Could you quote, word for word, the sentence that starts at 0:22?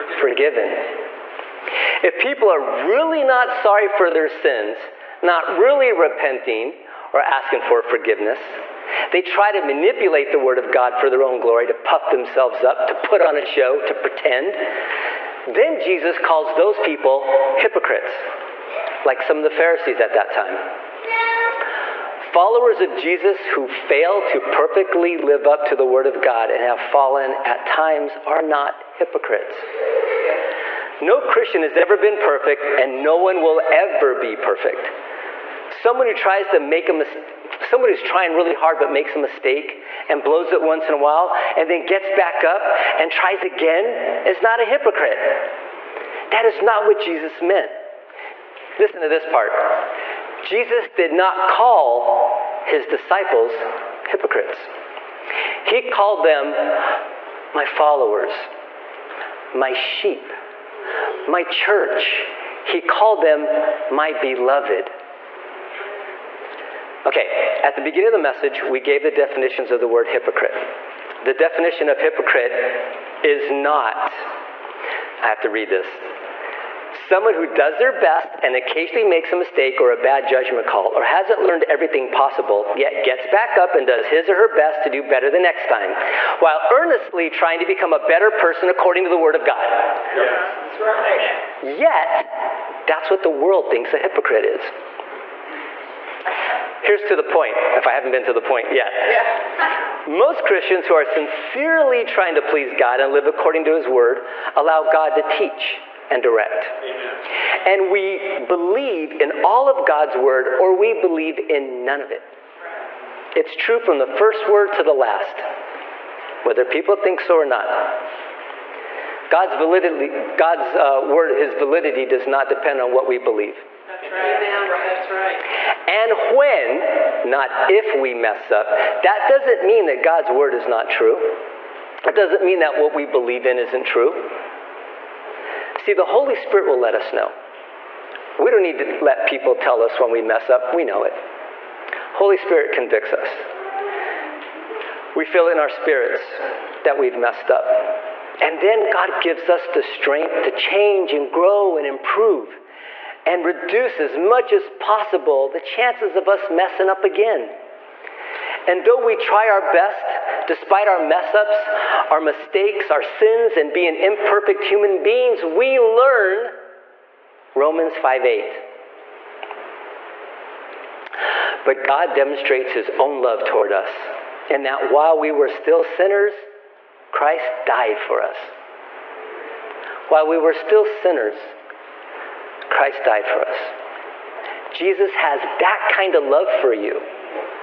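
Followers of Jesus who fail to perfectly live up to the Word of God and have fallen at times are not hypocrites.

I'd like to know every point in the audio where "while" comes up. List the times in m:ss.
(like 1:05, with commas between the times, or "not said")
0:40, 1:26, 2:54, 3:00.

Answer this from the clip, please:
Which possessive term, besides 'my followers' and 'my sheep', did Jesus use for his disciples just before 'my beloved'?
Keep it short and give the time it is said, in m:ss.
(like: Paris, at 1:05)
my church, at 1:01.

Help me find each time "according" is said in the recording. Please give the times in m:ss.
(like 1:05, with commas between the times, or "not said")
1:28, 1:43.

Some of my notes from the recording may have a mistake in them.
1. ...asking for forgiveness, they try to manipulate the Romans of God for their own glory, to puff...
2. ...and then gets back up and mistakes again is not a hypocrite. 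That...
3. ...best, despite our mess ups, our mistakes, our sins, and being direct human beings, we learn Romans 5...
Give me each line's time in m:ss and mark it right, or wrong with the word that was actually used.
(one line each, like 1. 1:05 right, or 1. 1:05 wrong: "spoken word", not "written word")
1. 0:07 wrong: "Word", not "Romans"
2. 0:41 wrong: "tries", not "mistakes"
3. 2:39 wrong: "imperfect", not "direct".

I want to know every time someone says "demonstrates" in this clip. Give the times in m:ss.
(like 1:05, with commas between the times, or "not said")
2:52.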